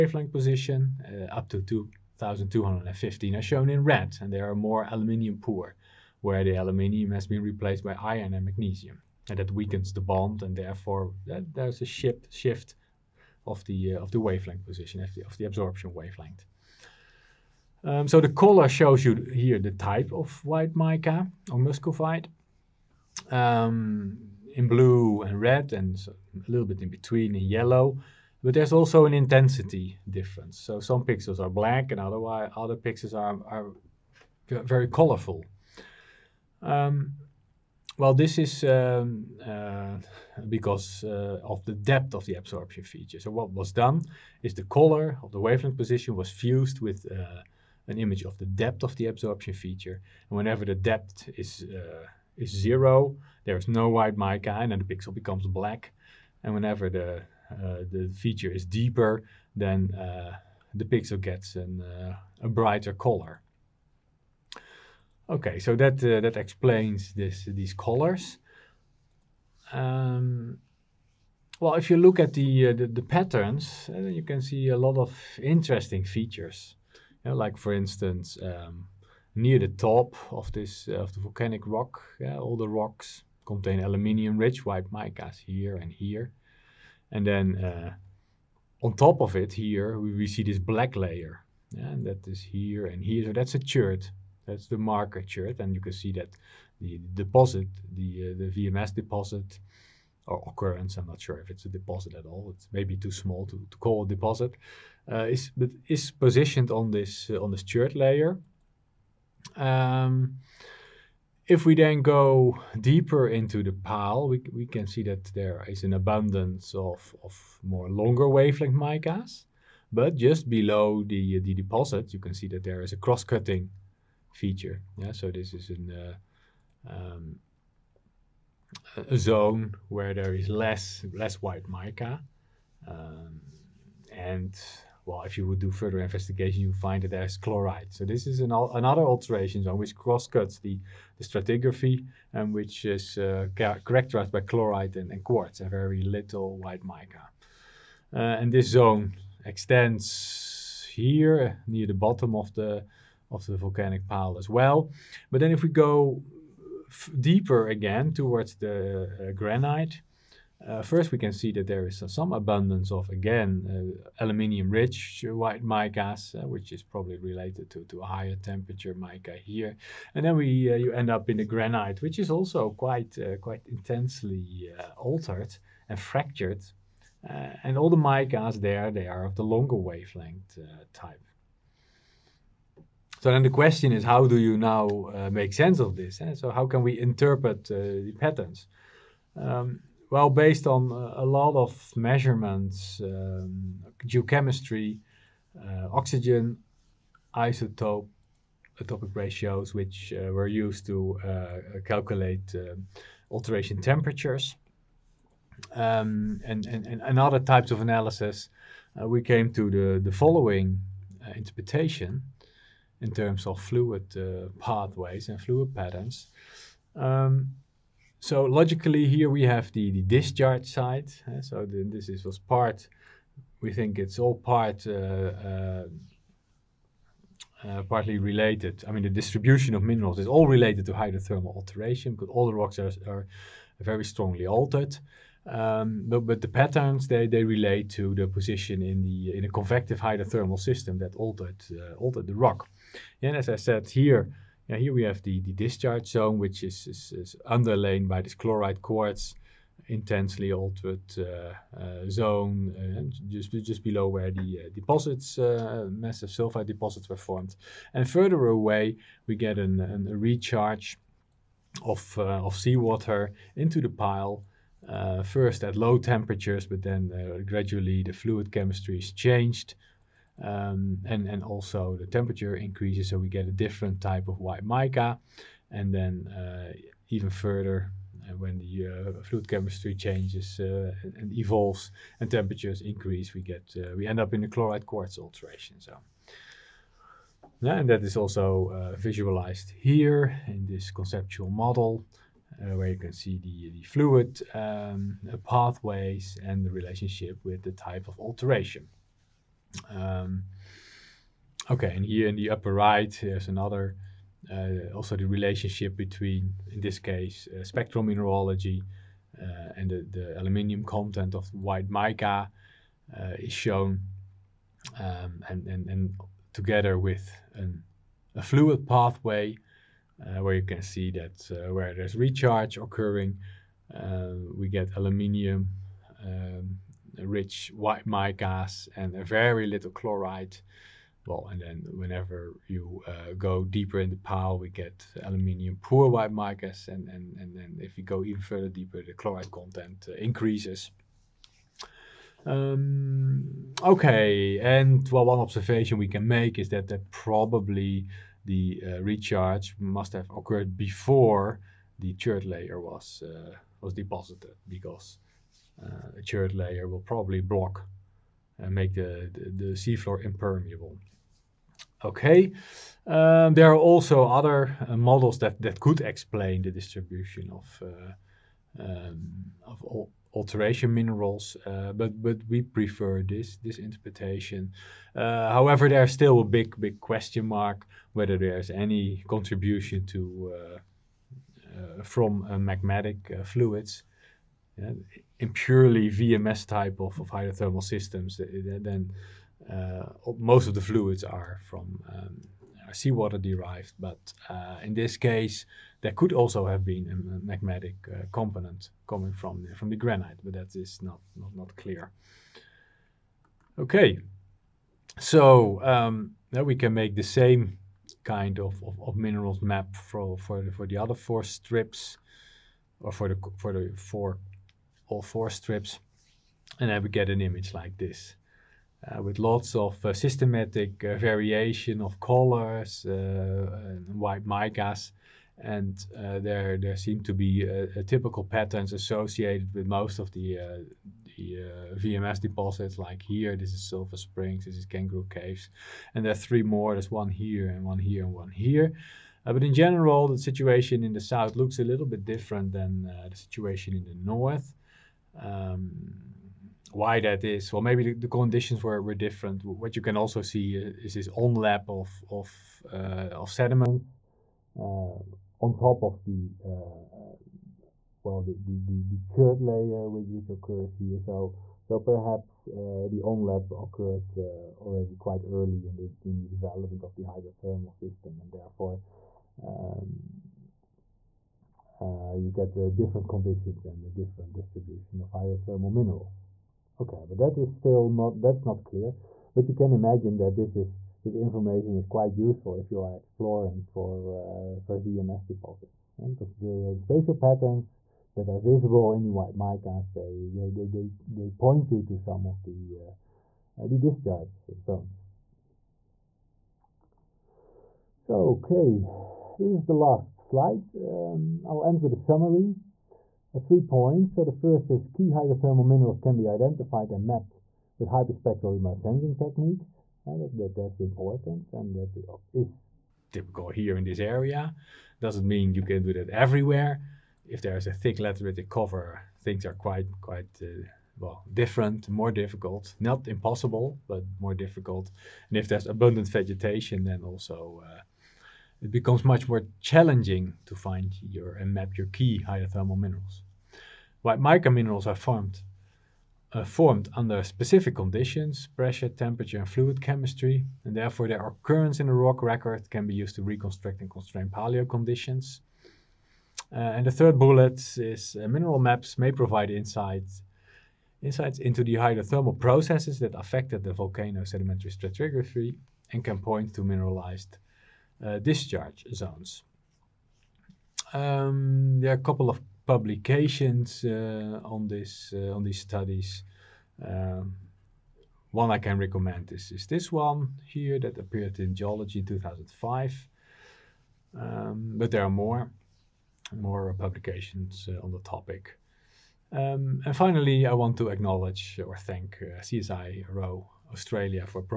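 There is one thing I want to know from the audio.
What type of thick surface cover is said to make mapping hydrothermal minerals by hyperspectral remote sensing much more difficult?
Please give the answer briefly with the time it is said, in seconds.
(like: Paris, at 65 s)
Lateritic cover, at 518 s.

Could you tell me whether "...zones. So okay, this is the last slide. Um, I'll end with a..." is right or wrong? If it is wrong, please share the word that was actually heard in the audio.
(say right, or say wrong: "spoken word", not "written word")
right.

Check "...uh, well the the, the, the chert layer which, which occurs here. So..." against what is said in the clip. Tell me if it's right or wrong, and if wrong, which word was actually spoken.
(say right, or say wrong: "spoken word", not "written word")
right.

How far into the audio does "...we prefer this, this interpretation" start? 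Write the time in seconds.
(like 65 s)
372 s.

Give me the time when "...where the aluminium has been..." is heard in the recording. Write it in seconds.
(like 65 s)
6 s.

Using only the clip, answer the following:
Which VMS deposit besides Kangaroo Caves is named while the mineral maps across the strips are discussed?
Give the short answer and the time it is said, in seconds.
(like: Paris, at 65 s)
Silver Springs, at 433 s.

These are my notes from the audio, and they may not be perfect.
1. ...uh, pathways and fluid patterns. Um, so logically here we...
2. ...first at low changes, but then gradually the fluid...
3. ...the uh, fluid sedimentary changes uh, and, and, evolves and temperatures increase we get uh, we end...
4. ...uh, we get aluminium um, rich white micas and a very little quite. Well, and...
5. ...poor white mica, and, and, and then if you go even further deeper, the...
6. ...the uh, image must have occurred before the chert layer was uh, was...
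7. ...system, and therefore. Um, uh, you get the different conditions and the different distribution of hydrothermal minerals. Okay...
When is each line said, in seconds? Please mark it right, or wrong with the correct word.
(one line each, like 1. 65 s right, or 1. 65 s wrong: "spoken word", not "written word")
1. 214 s right
2. 265 s wrong: "temperatures", not "changes"
3. 278 s wrong: "chemistry", not "sedimentary"
4. 323 s wrong: "chlorite", not "quite"
5. 335 s right
6. 348 s wrong: "recharge", not "image"
7. 467 s right.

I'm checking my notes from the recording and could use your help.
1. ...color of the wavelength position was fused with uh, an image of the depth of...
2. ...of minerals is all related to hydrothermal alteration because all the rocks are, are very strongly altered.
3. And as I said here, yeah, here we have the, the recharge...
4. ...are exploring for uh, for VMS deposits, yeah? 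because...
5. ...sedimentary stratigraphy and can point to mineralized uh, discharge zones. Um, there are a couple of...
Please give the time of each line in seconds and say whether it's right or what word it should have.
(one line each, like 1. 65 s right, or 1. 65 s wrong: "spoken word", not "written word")
1. 44 s right
2. 229 s right
3. 243 s wrong: "discharge", not "recharge"
4. 483 s right
5. 554 s right.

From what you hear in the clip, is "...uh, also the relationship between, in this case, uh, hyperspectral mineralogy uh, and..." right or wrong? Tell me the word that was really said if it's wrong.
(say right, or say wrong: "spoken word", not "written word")
wrong: "spectral", not "hyperspectral".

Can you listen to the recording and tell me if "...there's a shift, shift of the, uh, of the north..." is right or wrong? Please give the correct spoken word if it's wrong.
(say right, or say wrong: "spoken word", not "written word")
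wrong: "wavelength", not "north".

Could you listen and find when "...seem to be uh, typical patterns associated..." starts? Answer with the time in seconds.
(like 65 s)
426 s.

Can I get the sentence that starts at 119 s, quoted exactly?
But just below the, the deposit, you can see that there is a cross-cutting feature.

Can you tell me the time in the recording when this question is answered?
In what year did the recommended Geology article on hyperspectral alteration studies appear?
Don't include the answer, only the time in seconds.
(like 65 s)
572 s.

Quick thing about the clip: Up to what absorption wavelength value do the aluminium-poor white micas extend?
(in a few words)
2215.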